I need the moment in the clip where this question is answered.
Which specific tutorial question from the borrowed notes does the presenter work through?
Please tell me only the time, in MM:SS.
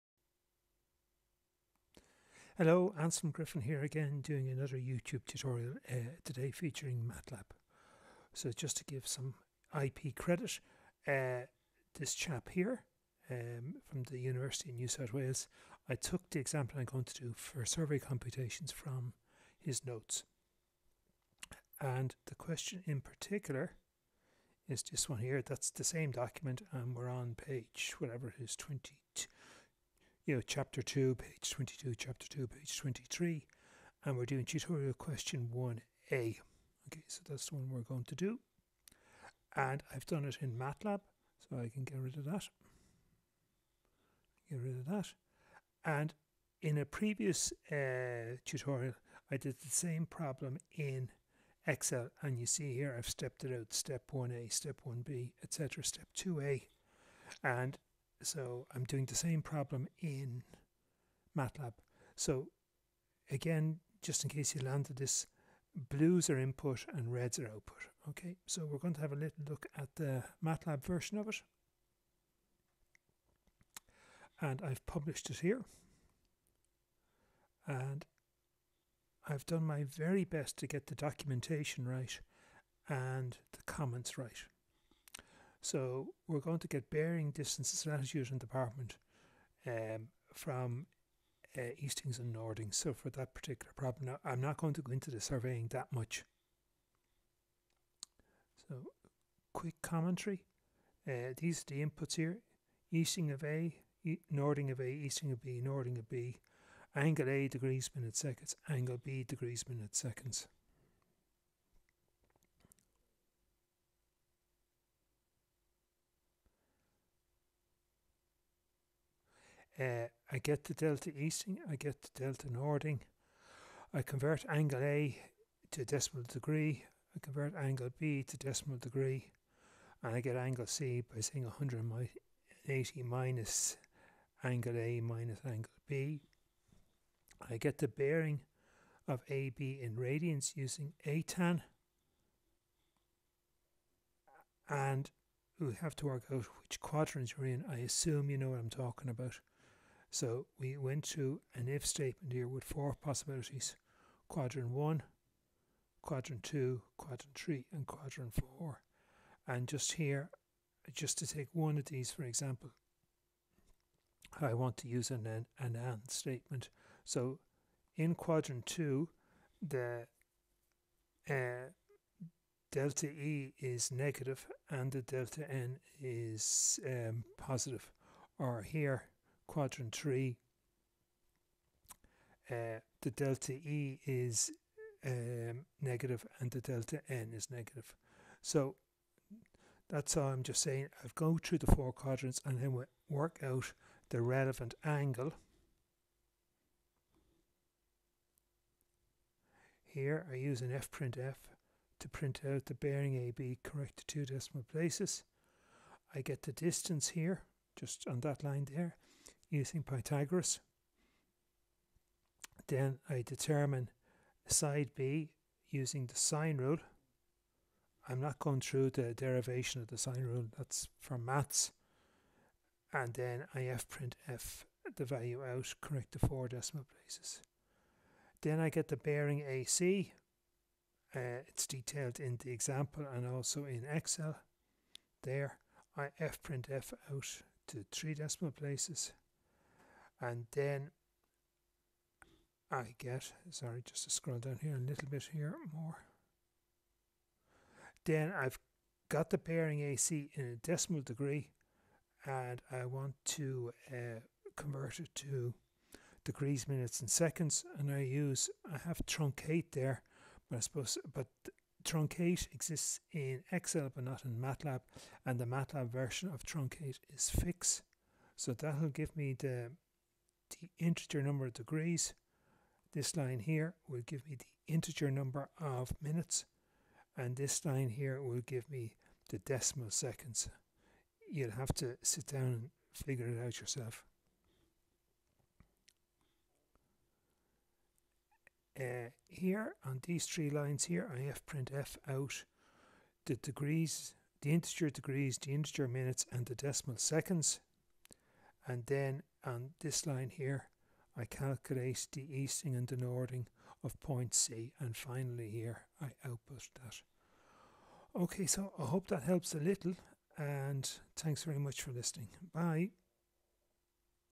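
00:34.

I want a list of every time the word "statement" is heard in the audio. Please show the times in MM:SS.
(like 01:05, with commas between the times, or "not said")
02:31, 02:46.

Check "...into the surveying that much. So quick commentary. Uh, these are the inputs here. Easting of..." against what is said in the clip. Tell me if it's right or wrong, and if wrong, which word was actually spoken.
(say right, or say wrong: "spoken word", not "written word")
right.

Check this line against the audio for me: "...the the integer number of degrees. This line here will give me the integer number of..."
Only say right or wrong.
right.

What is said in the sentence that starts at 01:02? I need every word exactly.
So again, just in case you landed this, blues are input and reds are output.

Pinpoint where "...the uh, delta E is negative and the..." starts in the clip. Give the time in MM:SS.
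02:49.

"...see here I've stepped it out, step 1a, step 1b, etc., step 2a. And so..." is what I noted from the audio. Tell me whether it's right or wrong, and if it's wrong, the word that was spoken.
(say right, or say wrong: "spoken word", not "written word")
right.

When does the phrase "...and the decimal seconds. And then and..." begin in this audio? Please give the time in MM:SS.
04:56.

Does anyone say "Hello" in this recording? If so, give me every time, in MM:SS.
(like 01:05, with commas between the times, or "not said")
00:02.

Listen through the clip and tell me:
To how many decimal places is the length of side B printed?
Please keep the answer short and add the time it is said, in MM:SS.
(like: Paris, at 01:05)
4, at 03:46.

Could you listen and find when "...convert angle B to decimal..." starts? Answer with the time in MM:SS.
02:07.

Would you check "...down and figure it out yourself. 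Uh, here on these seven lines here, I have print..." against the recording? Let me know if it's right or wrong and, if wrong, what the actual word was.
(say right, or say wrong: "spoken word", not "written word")
wrong: "three", not "seven".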